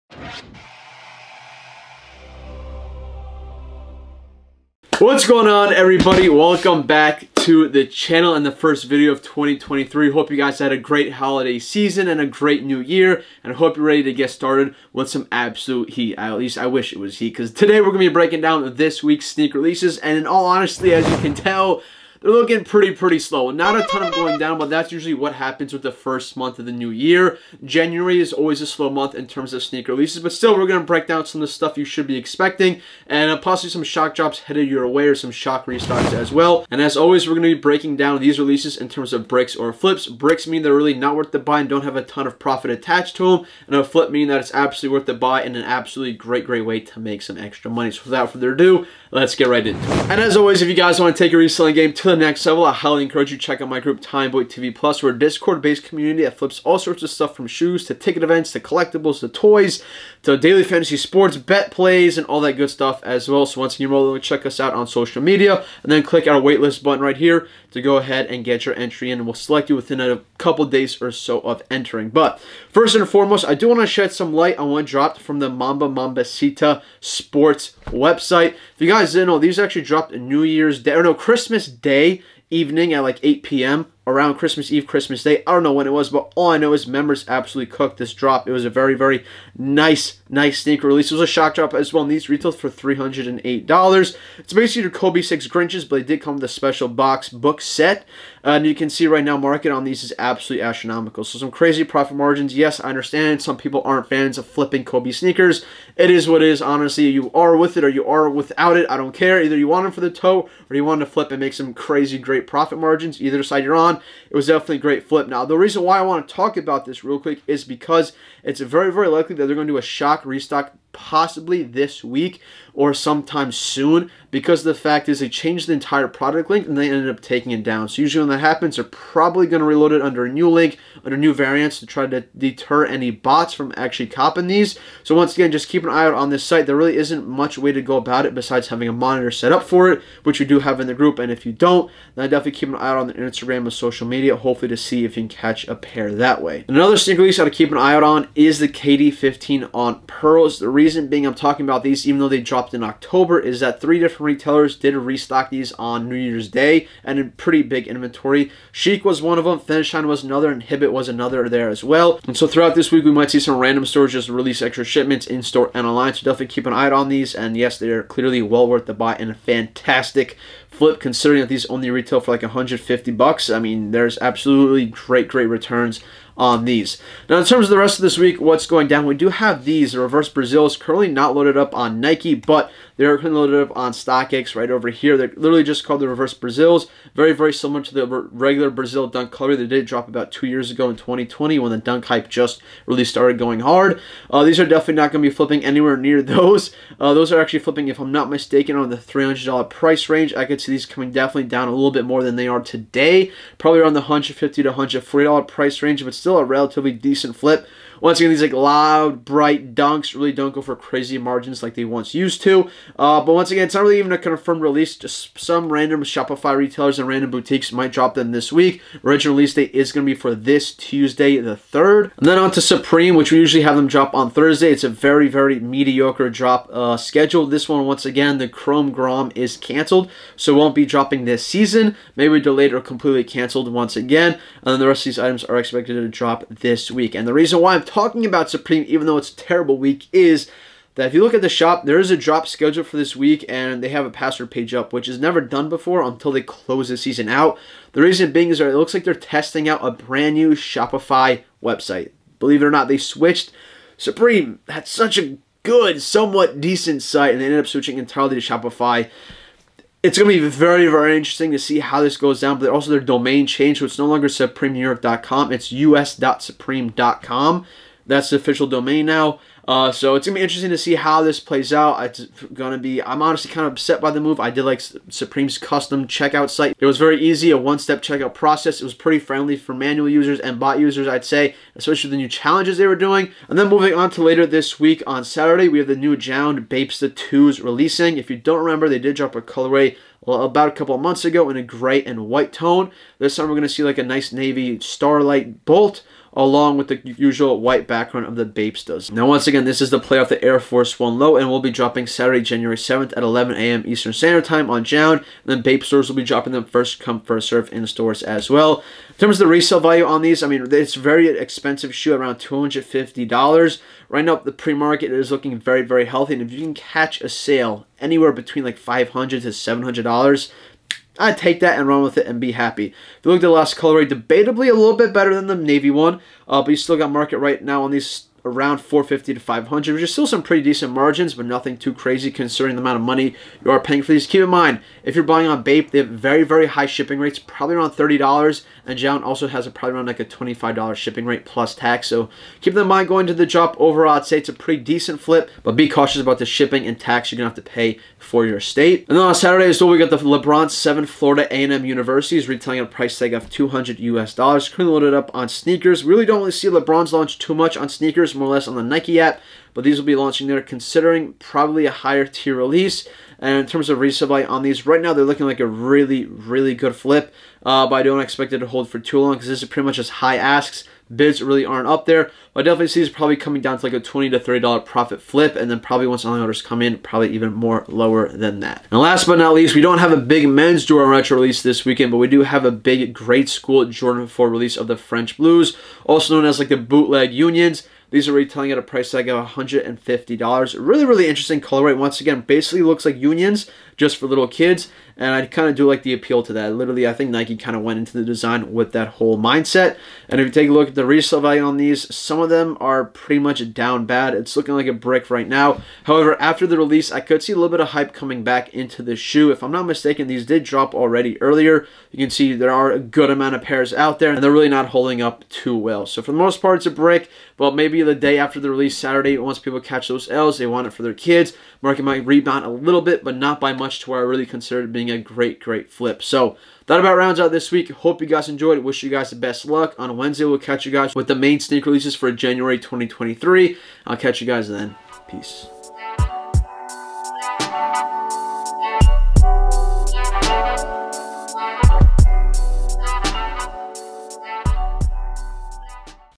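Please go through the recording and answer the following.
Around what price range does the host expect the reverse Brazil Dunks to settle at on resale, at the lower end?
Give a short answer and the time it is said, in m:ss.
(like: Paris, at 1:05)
$140, at 3:24.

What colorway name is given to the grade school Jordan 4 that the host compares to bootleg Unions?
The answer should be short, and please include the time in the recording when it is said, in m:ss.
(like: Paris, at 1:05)
French Blues, at 6:24.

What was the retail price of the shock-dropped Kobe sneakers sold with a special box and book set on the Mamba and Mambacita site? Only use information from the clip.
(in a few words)
$308.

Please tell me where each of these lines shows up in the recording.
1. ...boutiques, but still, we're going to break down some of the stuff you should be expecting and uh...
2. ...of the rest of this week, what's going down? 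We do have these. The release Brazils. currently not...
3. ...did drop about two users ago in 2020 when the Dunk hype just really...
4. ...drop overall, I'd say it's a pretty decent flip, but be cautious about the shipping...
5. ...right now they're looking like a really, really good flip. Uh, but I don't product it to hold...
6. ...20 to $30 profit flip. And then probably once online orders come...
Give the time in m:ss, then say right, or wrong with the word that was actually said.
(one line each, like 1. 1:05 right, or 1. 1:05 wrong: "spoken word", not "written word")
1. 0:29 wrong: "releases", not "boutiques"
2. 2:57 wrong: "reverse", not "release"
3. 3:09 wrong: "years", not "users"
4. 5:43 right
5. 6:04 wrong: "expect", not "product"
6. 6:13 right.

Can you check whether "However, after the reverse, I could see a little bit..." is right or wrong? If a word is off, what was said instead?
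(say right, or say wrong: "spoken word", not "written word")
wrong: "release", not "reverse".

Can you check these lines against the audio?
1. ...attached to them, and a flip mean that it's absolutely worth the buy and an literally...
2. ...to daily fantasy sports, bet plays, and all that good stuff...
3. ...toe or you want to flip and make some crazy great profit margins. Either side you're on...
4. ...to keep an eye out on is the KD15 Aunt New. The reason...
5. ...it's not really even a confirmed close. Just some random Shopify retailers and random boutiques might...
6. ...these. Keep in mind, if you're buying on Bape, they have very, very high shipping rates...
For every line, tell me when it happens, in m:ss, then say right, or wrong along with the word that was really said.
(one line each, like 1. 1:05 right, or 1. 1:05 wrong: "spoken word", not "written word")
1. 0:42 wrong: "absolutely", not "literally"
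2. 1:00 right
3. 1:50 right
4. 2:27 wrong: "Pearls", not "New"
5. 3:33 wrong: "release", not "close"
6. 5:34 right.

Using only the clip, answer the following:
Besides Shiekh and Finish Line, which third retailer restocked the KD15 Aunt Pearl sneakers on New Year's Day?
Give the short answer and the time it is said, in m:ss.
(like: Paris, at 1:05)
Hibbett, at 2:40.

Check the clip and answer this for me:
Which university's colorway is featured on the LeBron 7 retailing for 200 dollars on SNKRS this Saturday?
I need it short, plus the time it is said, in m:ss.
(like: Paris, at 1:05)
Florida A&M University, at 5:51.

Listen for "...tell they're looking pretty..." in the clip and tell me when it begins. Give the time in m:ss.
0:21.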